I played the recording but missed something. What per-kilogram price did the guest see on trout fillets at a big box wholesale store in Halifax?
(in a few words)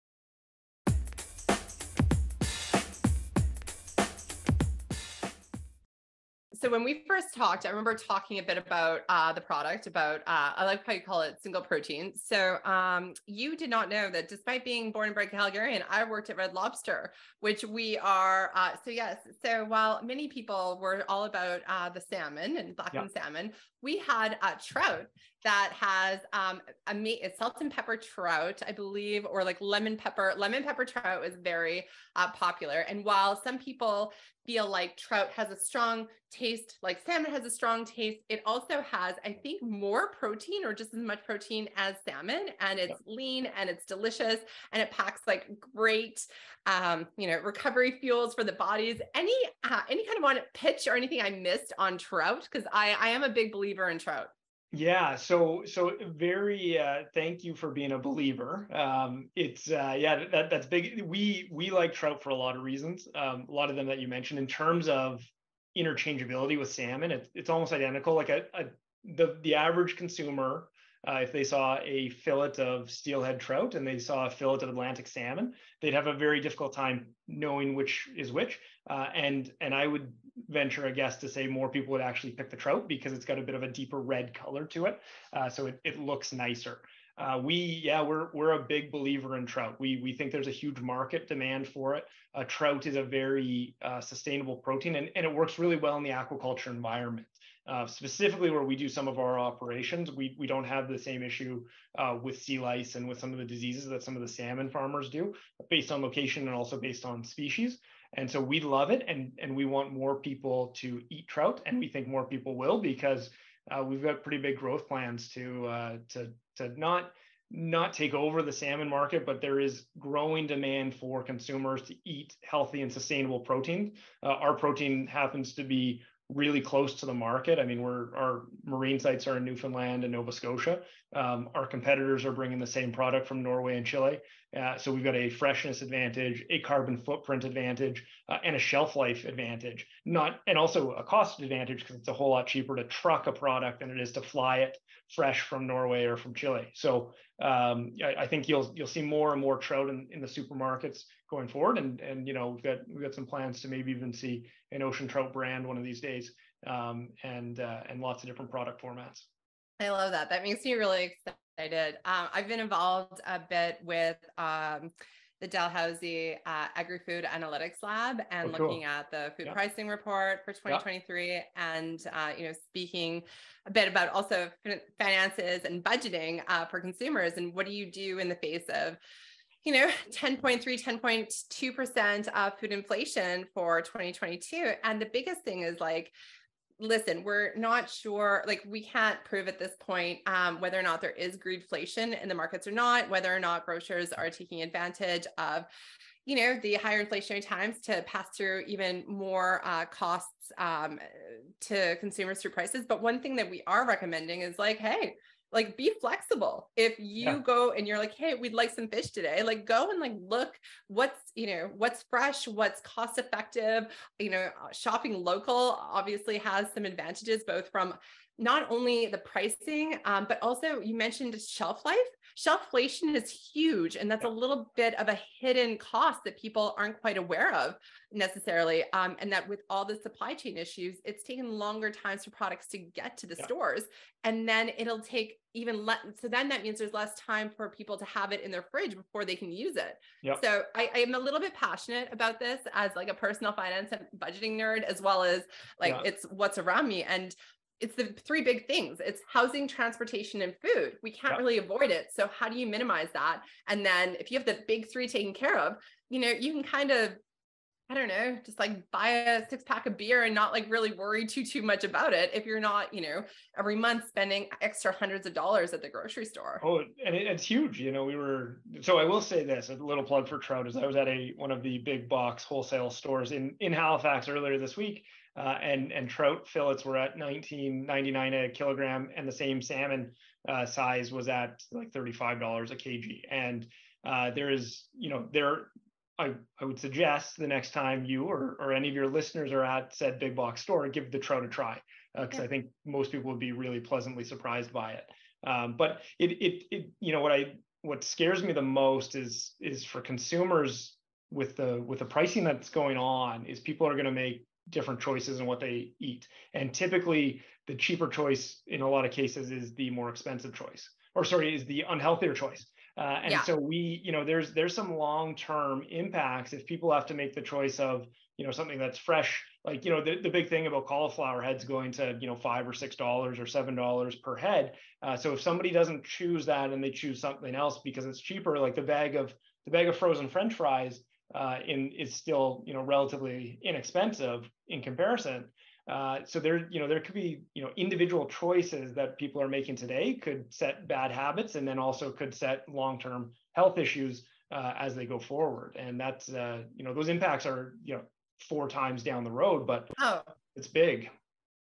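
$19.99.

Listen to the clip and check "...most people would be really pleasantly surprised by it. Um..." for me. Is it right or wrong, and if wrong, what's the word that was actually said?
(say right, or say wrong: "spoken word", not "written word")
right.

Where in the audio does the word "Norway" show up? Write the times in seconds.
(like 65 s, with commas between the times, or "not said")
133 s, 145 s.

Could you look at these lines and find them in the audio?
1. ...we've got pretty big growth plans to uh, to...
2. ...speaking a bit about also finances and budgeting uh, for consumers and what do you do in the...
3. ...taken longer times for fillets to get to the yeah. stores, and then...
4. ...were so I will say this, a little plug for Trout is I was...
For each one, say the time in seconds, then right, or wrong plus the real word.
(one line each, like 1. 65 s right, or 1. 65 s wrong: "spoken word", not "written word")
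1. 113 s right
2. 172 s right
3. 231 s wrong: "products", not "fillets"
4. 268 s right.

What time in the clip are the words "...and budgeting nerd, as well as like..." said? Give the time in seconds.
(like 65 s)
243 s.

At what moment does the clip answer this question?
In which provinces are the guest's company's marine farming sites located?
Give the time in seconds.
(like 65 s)
129 s.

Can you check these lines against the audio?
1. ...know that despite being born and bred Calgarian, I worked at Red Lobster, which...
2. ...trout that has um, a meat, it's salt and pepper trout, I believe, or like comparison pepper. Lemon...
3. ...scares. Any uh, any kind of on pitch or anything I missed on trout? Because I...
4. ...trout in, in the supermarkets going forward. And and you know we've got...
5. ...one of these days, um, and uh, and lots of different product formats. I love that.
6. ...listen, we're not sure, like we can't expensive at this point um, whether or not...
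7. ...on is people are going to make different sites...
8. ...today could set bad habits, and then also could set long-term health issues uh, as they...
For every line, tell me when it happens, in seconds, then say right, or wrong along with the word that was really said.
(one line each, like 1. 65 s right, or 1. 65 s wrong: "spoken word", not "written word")
1. 13 s right
2. 24 s wrong: "lemon", not "comparison"
3. 48 s wrong: "bodies", not "scares"
4. 149 s right
5. 155 s right
6. 186 s wrong: "prove", not "expensive"
7. 302 s wrong: "choices", not "sites"
8. 339 s right.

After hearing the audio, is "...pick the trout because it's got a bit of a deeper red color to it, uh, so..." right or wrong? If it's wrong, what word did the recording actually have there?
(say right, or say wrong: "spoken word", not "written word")
right.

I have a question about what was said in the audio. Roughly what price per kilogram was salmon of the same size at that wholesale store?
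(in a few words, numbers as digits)
$35.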